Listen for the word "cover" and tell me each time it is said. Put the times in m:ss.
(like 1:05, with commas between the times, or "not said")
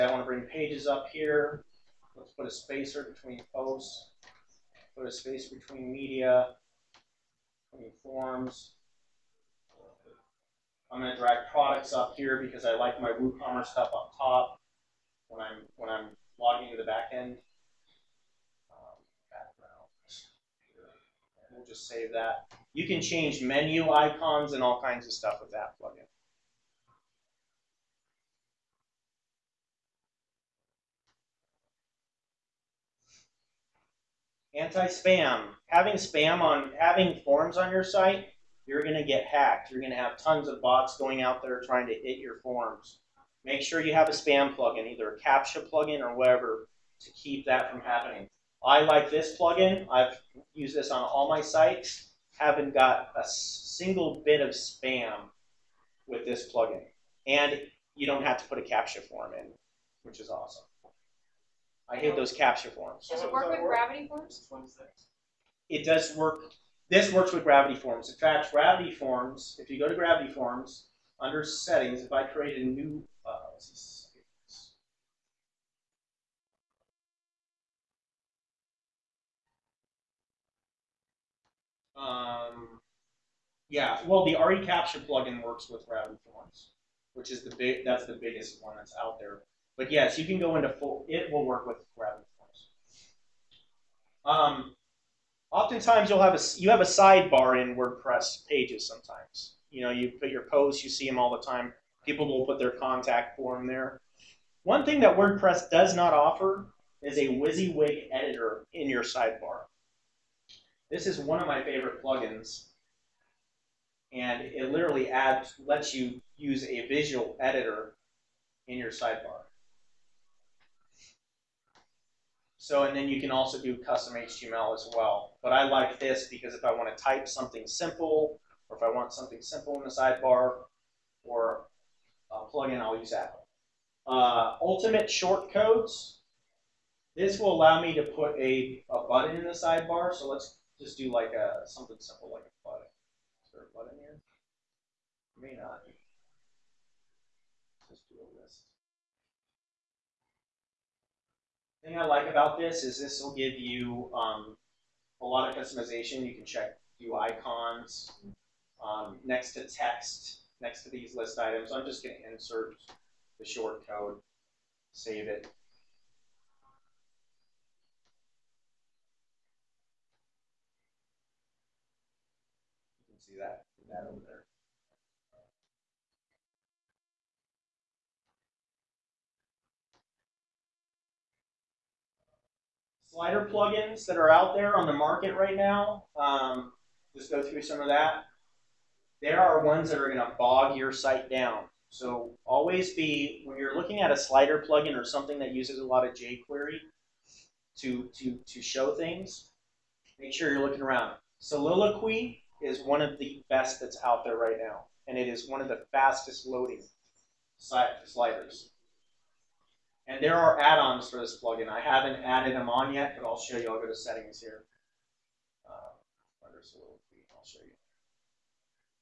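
not said.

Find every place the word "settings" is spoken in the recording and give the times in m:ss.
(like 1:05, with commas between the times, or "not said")
1:11, 3:33.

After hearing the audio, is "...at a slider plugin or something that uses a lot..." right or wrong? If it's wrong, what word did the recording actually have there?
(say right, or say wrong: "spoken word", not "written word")
right.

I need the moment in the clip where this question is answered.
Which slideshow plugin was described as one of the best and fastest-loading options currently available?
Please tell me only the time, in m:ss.
3:21.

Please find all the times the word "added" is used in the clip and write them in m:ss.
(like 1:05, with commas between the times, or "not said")
3:32.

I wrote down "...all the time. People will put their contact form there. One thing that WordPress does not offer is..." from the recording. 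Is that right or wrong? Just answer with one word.
right.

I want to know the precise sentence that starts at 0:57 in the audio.
And you don't have to put a CAPTCHA form in, which is awesome.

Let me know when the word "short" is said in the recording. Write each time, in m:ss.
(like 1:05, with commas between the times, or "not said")
2:15, 2:43.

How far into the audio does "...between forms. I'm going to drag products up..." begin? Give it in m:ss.
0:07.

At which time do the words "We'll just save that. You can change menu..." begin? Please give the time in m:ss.
0:21.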